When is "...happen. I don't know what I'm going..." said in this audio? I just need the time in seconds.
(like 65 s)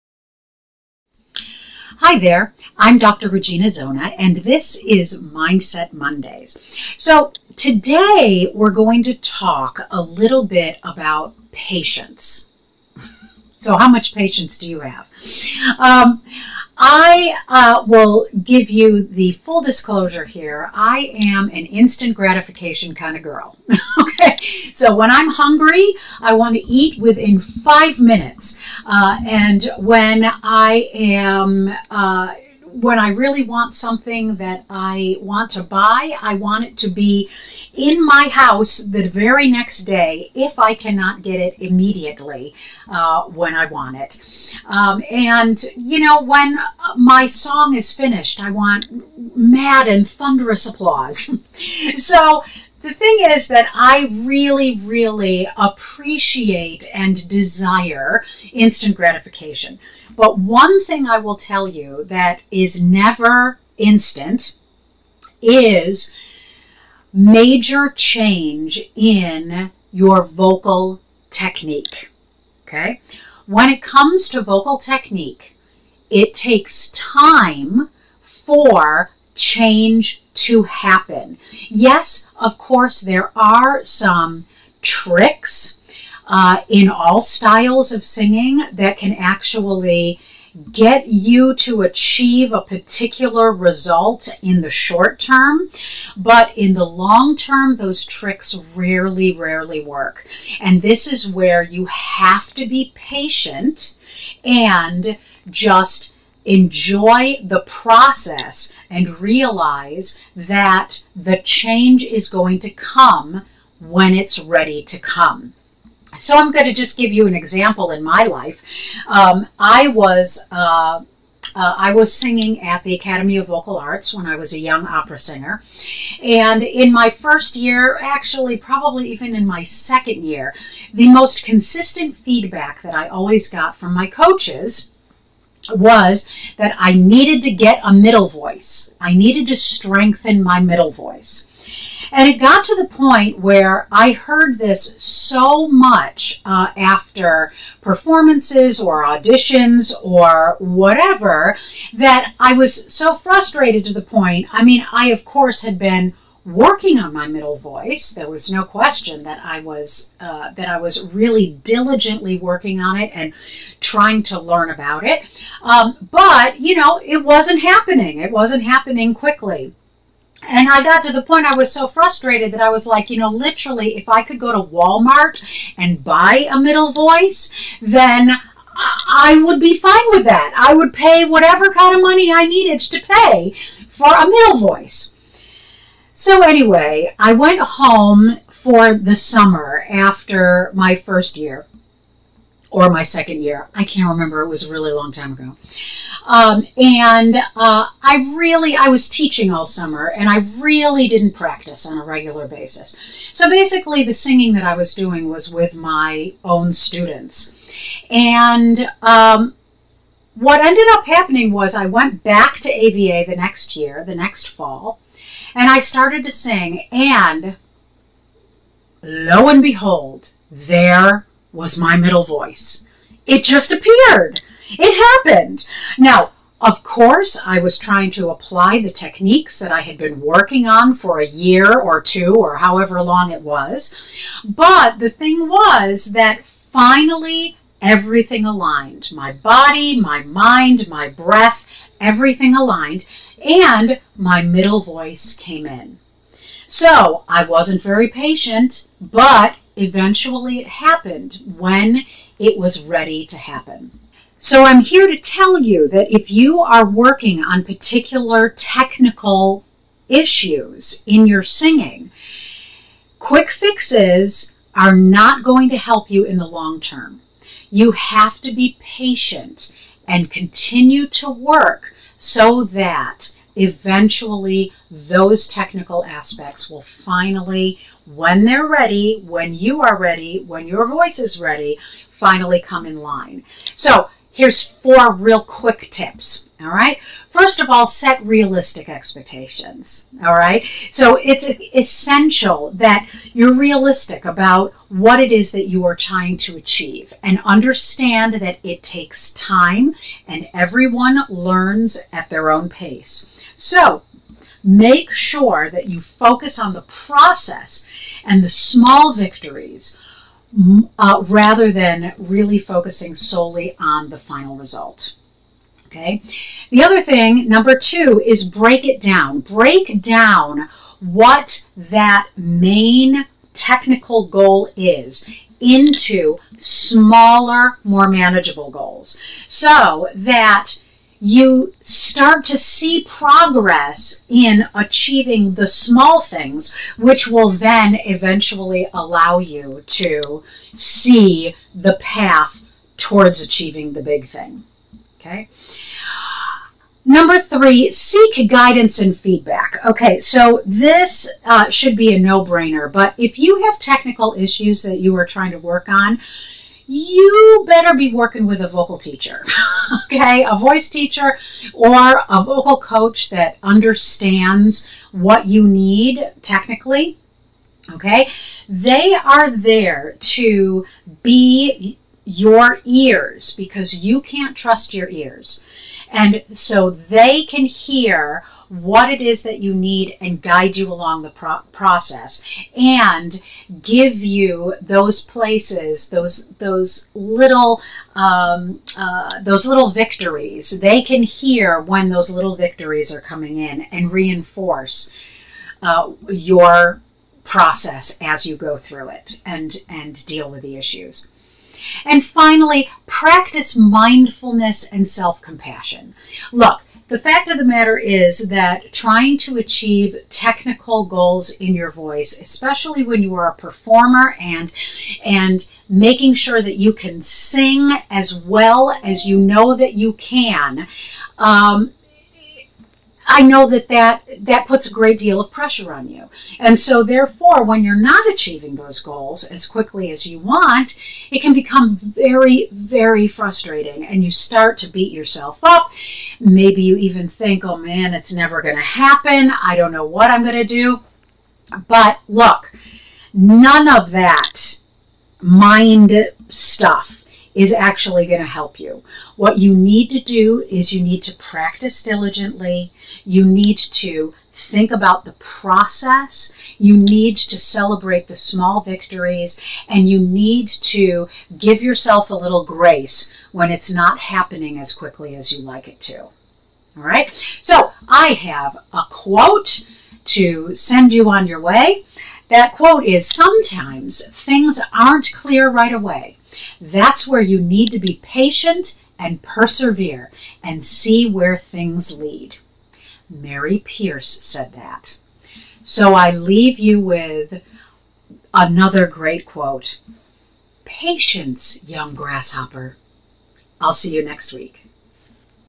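438 s.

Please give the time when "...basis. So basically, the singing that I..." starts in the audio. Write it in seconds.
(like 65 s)
202 s.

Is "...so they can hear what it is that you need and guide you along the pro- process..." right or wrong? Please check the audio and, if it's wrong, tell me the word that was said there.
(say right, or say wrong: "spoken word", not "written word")
right.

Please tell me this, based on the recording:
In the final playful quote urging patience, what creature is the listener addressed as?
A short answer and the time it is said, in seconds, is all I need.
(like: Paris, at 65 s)
young grasshopper, at 491 s.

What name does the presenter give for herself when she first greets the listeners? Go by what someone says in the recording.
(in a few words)
Dr. Regina Zona.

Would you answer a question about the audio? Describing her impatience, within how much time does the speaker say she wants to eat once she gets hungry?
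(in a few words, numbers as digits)
5 minutes.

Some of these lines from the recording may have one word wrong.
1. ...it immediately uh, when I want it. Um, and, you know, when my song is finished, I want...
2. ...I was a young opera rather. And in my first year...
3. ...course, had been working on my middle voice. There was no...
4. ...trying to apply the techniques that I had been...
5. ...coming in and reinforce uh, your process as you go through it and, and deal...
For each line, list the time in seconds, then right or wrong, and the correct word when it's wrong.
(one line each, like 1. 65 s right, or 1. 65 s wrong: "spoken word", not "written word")
1. 41 s right
2. 124 s wrong: "singer", not "rather"
3. 155 s right
4. 227 s right
5. 393 s right.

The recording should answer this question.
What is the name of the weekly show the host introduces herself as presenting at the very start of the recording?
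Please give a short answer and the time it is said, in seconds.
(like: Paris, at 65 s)
Mindset Mondays, at 5 s.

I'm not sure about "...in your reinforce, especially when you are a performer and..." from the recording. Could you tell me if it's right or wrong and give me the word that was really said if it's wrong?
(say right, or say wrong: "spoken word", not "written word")
wrong: "voice", not "reinforce".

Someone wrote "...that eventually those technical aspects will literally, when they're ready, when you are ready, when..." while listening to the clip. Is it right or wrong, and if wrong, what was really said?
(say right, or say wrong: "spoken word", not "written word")
wrong: "finally", not "literally".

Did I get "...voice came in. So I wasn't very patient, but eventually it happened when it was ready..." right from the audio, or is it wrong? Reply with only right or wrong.
right.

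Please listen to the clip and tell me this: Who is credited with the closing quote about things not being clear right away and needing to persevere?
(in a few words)
Mary Pierce.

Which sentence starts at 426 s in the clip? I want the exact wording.
And so, therefore, when you're not achieving those goals as quickly as you want, it can become very, very frustrating.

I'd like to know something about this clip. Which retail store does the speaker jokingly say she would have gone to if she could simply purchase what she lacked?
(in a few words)
Walmart.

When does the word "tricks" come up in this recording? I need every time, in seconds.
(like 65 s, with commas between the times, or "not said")
84 s, 98 s.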